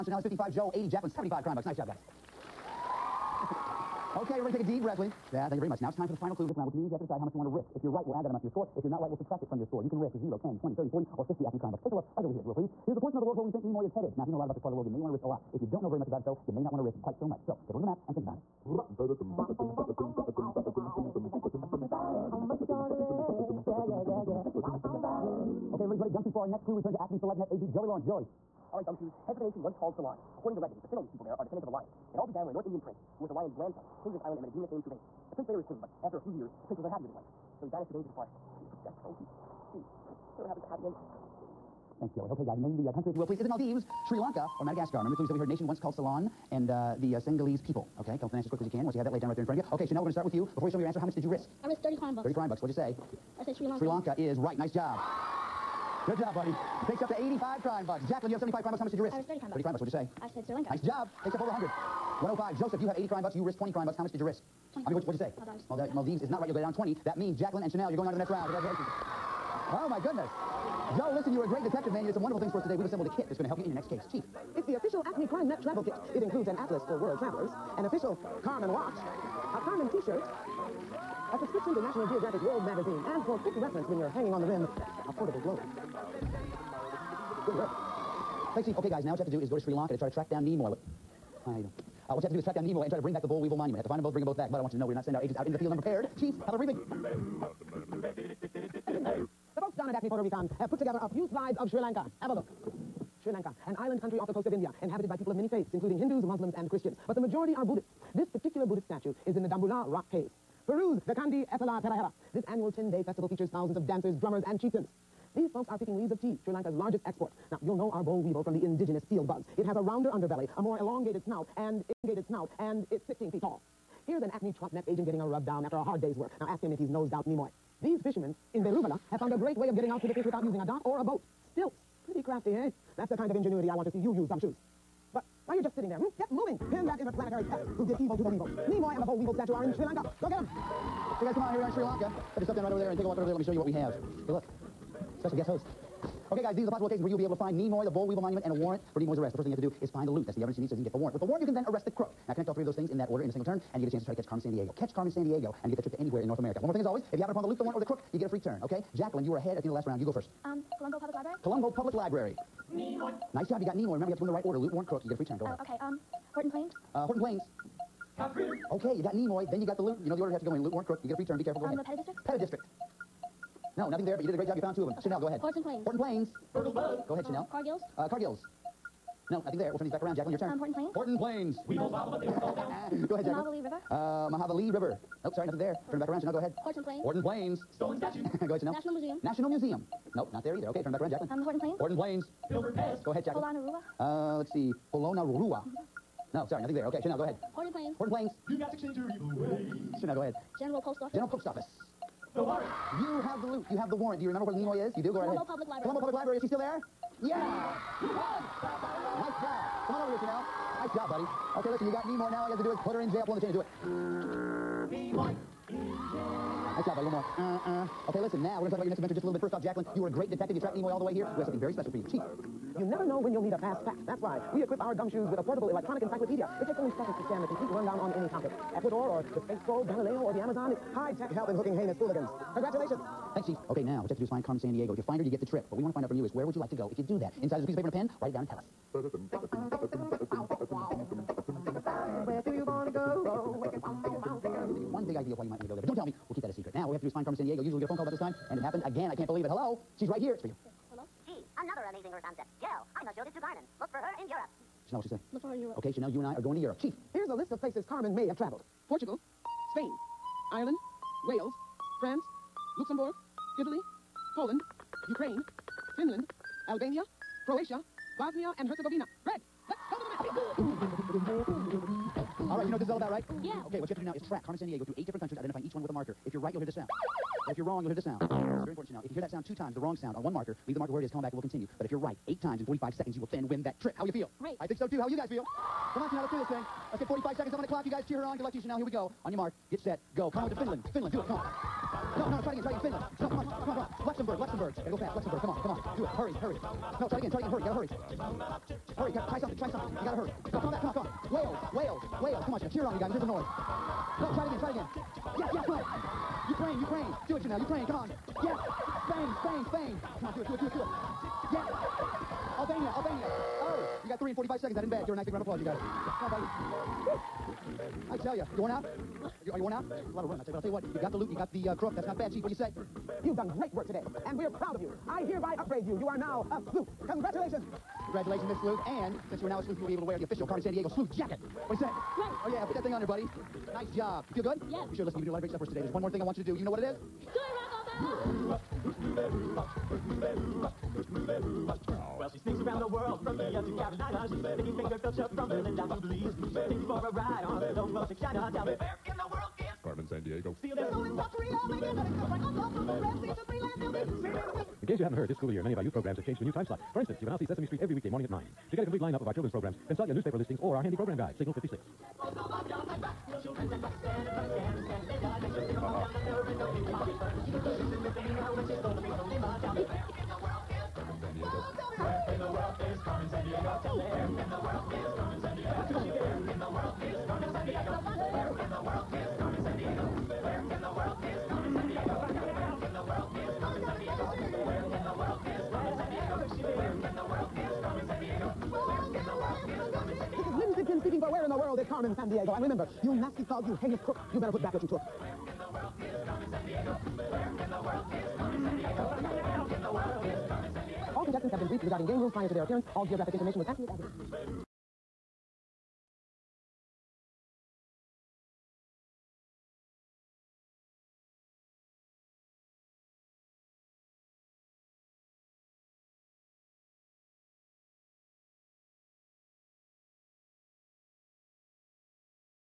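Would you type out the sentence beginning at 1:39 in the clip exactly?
The folks down at Acme Puerto Rican have put together a few slides of Sri Lanka.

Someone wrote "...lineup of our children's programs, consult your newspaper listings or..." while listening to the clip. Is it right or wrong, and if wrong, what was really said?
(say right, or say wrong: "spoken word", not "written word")
right.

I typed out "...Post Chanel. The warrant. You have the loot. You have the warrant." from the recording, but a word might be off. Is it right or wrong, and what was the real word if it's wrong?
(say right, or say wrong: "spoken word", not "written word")
wrong: "Office", not "Chanel".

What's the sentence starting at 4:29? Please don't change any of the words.
Greg, let's go to the I Feel good.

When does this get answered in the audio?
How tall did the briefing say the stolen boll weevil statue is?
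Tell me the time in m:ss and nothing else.
2:03.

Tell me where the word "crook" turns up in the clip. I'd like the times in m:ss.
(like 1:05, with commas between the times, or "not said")
2:31, 2:37, 2:44, 2:50, 5:21, 6:34.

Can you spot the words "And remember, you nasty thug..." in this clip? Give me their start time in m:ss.
6:32.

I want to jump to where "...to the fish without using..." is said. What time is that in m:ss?
2:10.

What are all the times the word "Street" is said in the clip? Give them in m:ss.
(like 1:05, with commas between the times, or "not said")
5:57.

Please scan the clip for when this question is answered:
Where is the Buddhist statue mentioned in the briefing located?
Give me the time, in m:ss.
1:49.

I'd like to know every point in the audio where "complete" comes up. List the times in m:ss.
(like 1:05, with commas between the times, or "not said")
3:47, 5:58.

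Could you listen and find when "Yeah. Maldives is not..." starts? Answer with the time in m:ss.
1:05.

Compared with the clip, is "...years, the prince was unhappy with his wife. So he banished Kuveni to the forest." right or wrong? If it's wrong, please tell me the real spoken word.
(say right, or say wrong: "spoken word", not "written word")
right.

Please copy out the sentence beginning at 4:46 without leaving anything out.
Let's get 45 seconds up on the clock.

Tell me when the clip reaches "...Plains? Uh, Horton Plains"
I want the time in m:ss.
2:46.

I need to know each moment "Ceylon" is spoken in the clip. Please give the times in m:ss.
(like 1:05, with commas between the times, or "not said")
0:29, 0:45.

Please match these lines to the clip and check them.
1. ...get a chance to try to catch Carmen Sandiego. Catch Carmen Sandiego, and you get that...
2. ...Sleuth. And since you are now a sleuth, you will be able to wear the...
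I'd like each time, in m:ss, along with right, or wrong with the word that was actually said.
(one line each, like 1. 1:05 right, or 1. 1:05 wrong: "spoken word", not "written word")
1. 2:33 right
2. 5:28 right.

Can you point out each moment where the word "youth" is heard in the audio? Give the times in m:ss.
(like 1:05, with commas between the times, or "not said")
5:55.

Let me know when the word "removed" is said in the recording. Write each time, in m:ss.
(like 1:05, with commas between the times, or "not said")
not said.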